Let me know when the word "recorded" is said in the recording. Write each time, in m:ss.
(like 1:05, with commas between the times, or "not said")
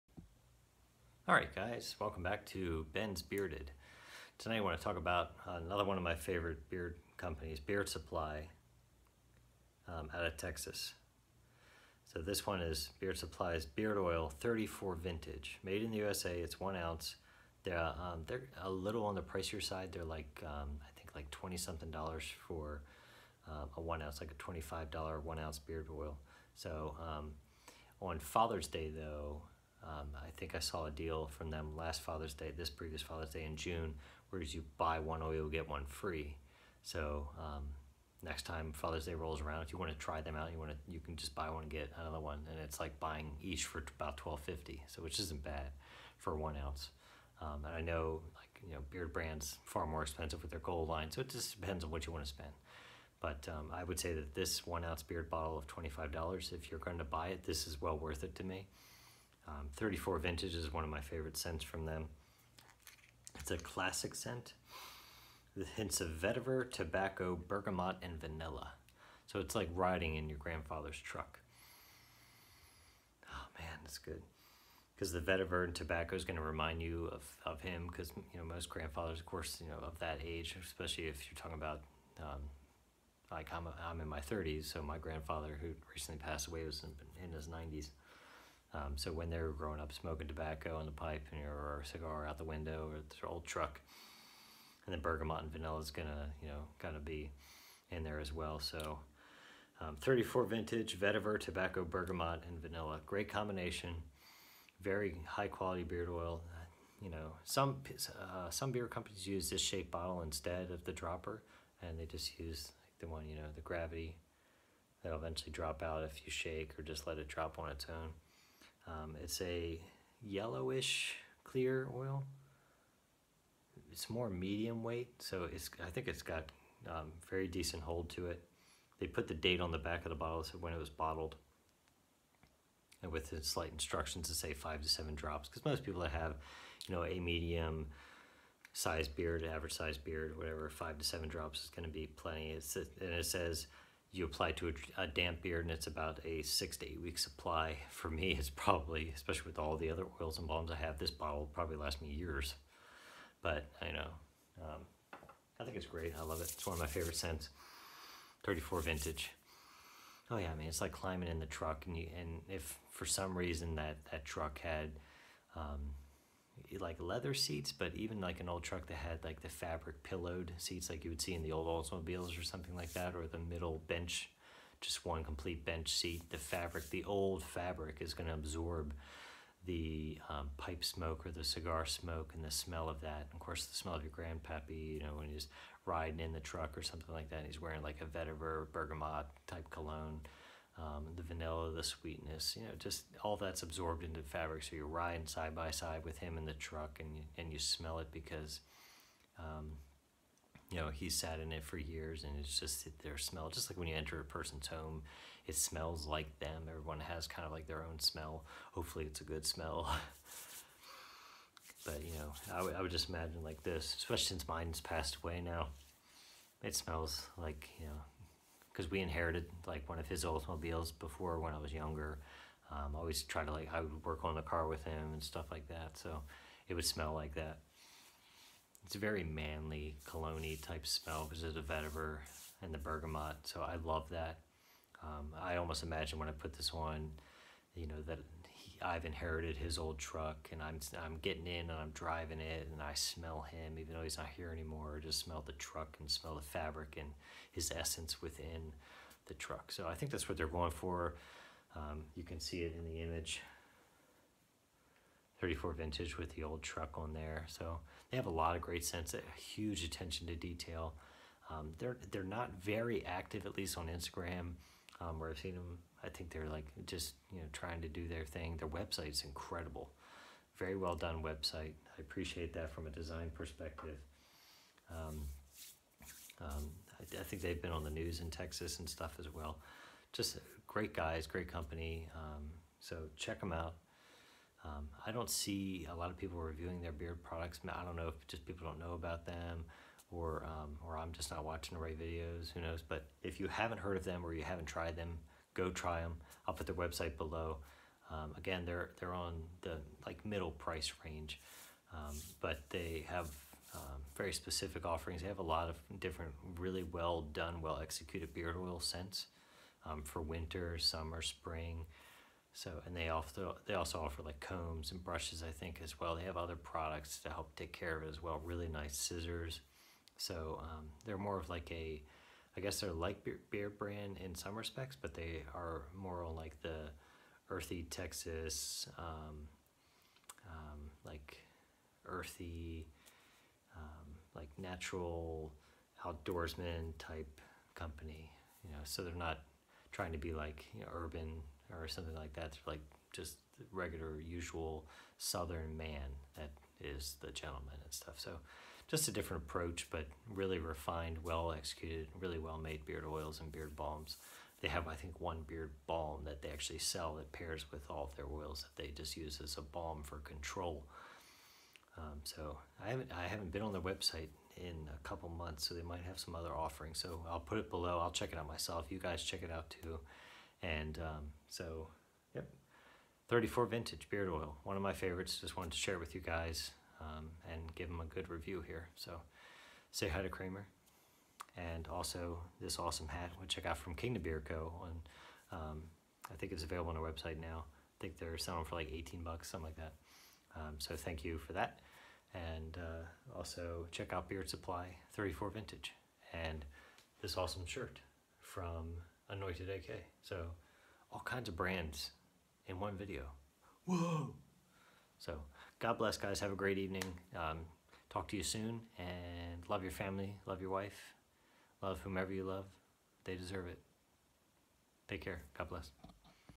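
not said.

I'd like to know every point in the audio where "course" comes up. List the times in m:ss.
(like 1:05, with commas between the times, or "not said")
1:19, 3:03.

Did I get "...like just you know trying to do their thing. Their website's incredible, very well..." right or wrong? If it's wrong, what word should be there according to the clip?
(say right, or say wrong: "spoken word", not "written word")
right.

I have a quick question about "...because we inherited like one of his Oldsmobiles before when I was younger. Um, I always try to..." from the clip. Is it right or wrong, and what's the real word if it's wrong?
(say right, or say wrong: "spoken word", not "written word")
right.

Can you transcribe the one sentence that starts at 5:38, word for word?
You know, so they're not trying to be like you know, urban or something like that.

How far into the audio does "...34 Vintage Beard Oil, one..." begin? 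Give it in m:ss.
6:13.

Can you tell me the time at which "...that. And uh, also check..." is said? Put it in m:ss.
6:31.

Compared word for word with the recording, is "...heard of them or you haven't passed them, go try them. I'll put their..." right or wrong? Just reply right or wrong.
wrong.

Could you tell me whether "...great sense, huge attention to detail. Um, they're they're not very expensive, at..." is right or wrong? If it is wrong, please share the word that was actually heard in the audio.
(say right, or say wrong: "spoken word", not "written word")
wrong: "active", not "expensive".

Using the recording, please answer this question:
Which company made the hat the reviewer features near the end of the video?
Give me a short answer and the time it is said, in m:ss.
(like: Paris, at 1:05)
King to Beer Co., at 6:23.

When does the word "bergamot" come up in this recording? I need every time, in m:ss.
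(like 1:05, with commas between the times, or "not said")
1:07, 1:35, 1:41, 3:08, 3:52.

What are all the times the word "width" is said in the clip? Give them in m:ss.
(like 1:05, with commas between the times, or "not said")
not said.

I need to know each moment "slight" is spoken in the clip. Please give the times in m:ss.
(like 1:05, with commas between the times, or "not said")
2:13.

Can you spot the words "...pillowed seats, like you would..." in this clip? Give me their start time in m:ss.
2:50.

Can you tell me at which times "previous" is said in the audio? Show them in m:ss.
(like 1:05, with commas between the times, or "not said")
0:32.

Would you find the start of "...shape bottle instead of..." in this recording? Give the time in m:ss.
1:49.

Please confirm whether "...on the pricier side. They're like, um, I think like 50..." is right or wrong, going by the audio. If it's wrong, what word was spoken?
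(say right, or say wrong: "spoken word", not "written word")
wrong: "20", not "50".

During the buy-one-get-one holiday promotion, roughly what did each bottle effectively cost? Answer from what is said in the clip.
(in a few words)
$12.50.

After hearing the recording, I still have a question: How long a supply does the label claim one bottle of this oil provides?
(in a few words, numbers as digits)
6 to 8 weeks.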